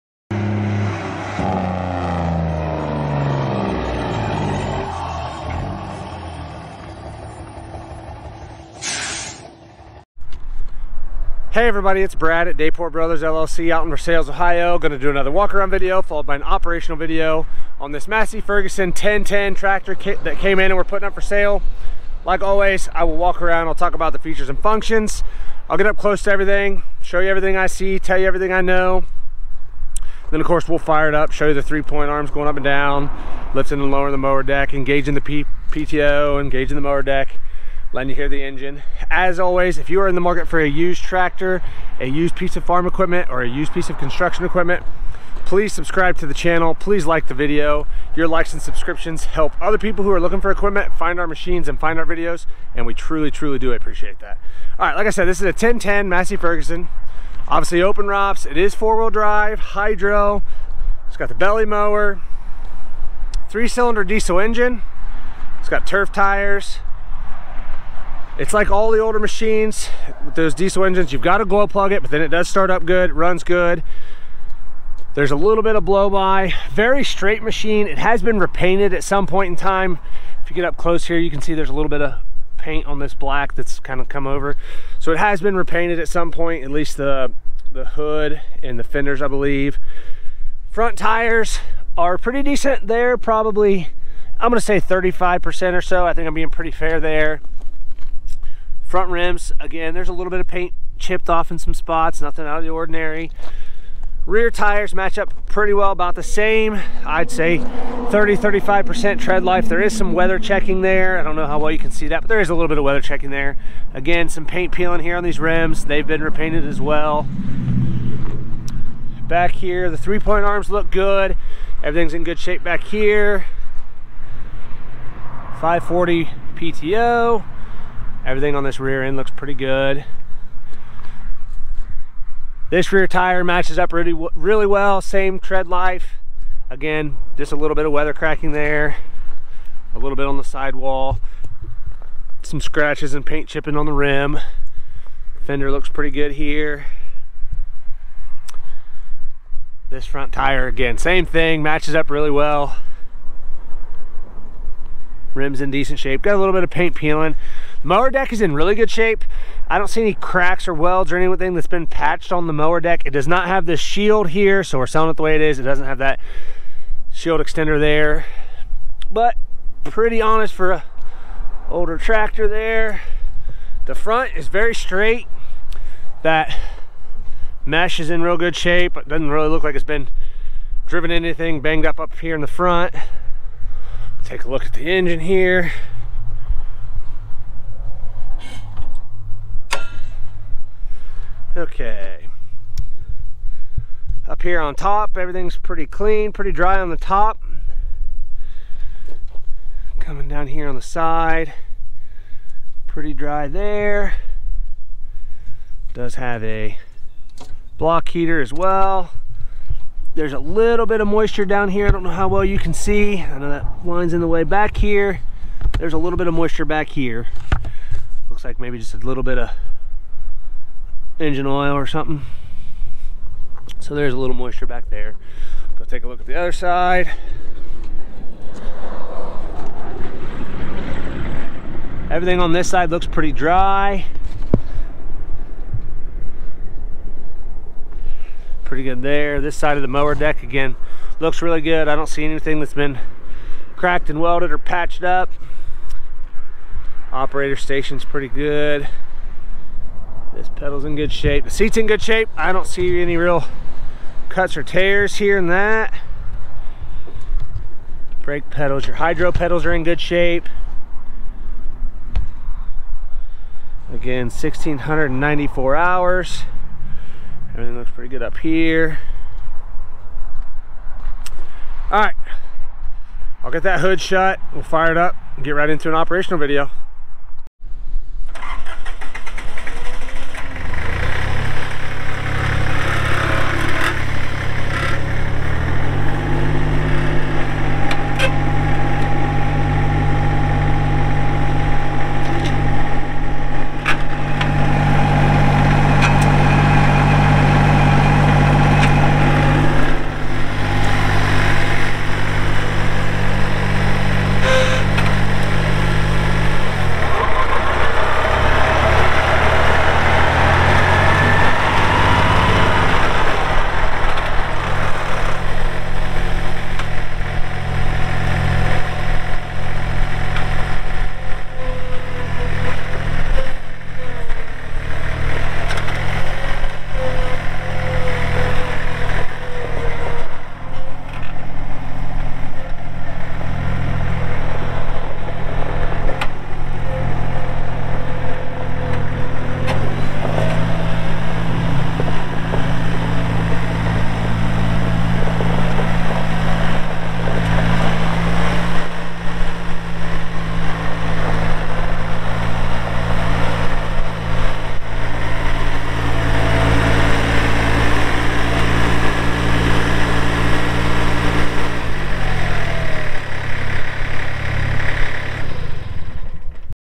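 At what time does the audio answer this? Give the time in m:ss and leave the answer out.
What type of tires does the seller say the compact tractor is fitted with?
1:05.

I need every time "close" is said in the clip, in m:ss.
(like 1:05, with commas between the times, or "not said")
0:25, 1:20.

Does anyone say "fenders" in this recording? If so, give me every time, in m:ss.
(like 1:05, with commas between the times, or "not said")
1:28, 2:25.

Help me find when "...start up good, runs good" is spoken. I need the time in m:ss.
1:12.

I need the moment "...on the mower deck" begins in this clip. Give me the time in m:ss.
2:42.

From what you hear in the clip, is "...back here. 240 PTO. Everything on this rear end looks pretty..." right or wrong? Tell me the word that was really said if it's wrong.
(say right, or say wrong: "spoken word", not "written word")
wrong: "540", not "240".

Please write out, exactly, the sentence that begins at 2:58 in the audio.
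It doesn't really look like it's been driven anything, banged up up here in the front.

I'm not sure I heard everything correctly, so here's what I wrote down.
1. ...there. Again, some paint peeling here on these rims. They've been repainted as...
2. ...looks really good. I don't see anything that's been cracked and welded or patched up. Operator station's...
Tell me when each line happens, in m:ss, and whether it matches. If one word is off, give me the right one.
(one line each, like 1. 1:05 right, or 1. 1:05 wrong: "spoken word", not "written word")
1. 1:53 right
2. 4:01 right.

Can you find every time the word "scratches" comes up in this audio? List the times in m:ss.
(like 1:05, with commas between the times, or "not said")
2:22.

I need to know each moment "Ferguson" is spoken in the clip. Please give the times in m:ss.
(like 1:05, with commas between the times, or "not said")
0:18, 0:56.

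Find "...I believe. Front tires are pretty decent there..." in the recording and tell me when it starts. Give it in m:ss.
1:29.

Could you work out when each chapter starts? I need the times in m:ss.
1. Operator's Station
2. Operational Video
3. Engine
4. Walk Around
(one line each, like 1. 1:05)
1. 4:06
2. 4:37
3. 3:10
4. 0:10.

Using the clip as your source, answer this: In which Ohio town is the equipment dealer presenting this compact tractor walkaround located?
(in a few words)
Versailles.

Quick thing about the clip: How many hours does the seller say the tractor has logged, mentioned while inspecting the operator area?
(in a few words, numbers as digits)
1,694.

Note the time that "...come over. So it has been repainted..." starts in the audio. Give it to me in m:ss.
1:24.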